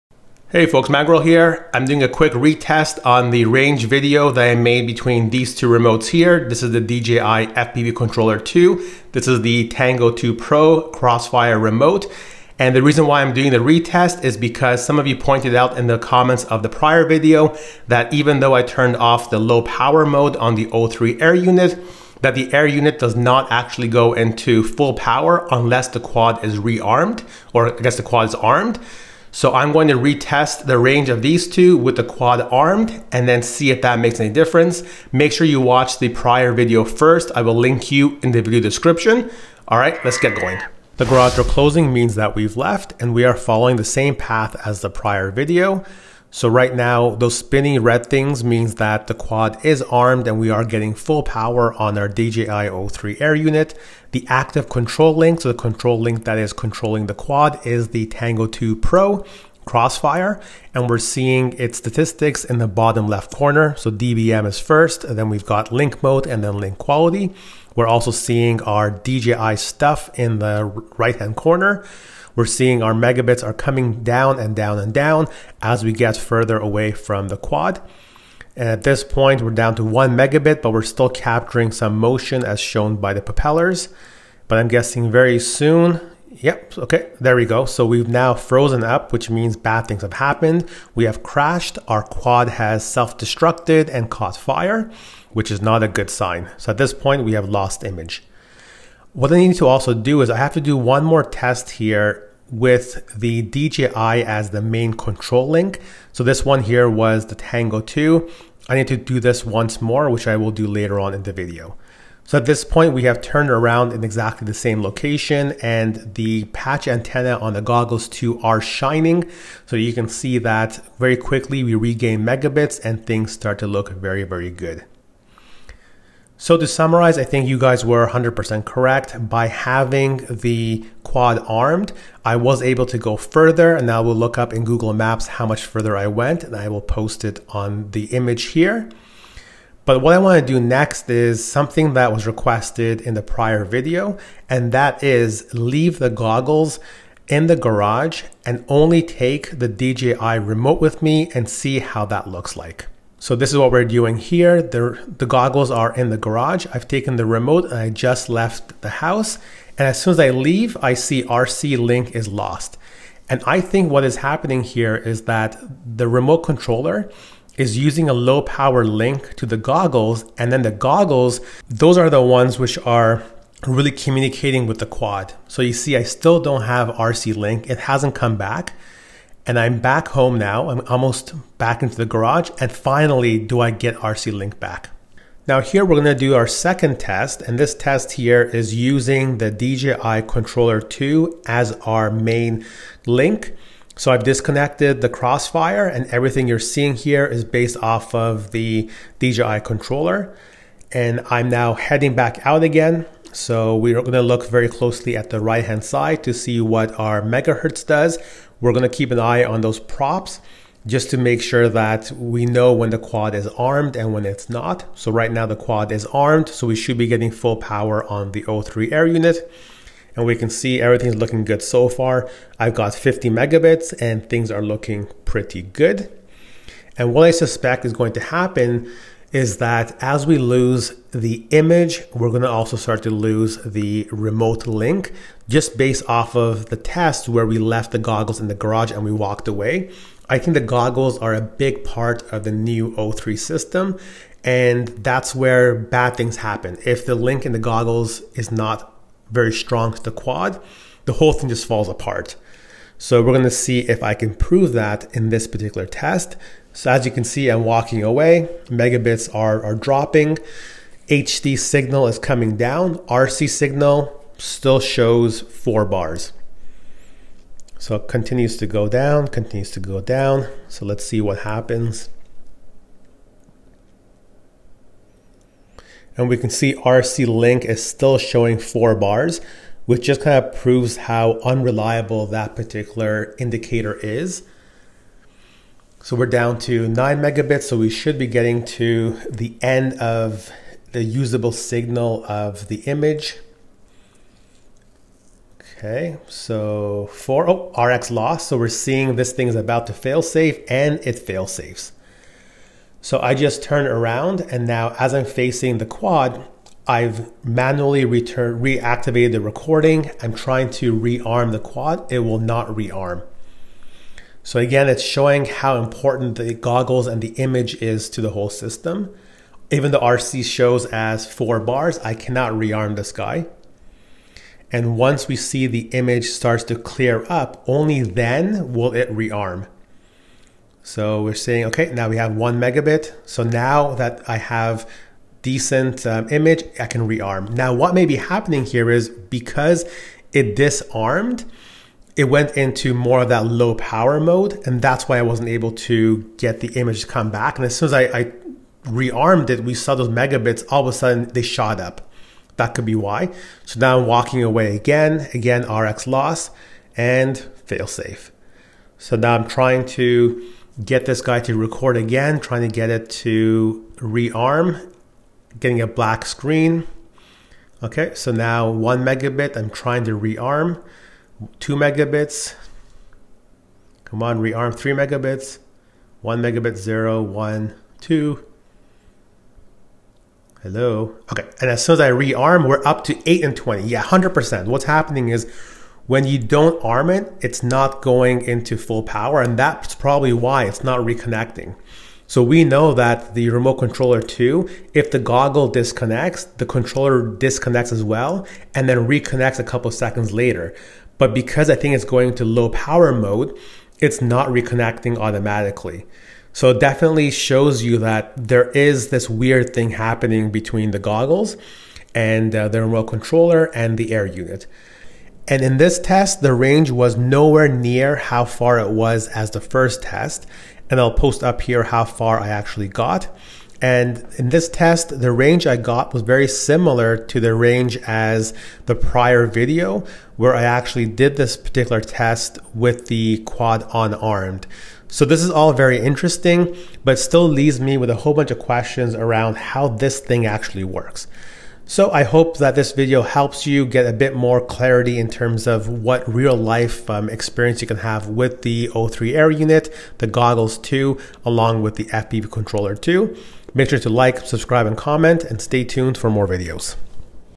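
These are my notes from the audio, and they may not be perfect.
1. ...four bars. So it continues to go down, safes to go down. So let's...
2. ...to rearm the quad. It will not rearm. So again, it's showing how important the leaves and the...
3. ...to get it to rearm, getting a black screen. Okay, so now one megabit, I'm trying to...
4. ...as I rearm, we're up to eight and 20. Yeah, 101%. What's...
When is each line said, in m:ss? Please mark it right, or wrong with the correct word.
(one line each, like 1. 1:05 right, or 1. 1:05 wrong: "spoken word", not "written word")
1. 4:25 wrong: "continues", not "safes"
2. 5:10 wrong: "goggles", not "leaves"
3. 6:02 right
4. 6:21 wrong: "100", not "101".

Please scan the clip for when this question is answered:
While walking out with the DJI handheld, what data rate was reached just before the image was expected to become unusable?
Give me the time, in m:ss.
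4:46.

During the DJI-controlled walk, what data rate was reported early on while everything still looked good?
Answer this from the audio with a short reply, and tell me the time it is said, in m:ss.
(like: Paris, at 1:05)
50 megabits, at 3:42.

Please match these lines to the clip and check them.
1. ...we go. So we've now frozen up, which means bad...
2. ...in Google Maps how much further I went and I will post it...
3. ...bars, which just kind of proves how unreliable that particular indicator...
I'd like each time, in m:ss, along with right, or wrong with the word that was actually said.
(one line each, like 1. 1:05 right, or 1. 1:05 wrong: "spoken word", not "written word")
1. 1:27 right
2. 2:14 right
3. 4:38 right.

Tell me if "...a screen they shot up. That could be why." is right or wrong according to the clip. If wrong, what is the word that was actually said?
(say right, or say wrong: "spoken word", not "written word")
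wrong: "sudden", not "screen".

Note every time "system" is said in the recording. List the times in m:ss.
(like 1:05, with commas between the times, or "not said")
4:03, 5:18.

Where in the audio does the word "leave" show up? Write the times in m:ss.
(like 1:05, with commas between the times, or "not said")
2:25, 2:40, 7:17.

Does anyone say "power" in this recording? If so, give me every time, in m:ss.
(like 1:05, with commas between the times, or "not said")
0:19, 0:24, 0:51, 2:48, 3:37, 5:43, 6:29, 6:42.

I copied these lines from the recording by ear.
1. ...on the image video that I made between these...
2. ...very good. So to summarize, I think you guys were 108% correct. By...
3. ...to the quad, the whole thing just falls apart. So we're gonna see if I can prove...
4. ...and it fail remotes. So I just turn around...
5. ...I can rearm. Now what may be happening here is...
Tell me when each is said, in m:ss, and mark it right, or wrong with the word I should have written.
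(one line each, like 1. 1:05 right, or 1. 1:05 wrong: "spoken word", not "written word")
1. 0:03 wrong: "range", not "image"
2. 2:04 wrong: "100", not "108"
3. 4:09 right
4. 5:00 wrong: "safes", not "remotes"
5. 5:36 right.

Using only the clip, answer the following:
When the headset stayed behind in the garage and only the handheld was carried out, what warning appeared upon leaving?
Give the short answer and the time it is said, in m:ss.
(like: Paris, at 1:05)
RC link is lost, at 2:41.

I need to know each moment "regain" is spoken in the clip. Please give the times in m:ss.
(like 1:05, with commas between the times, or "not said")
2:01.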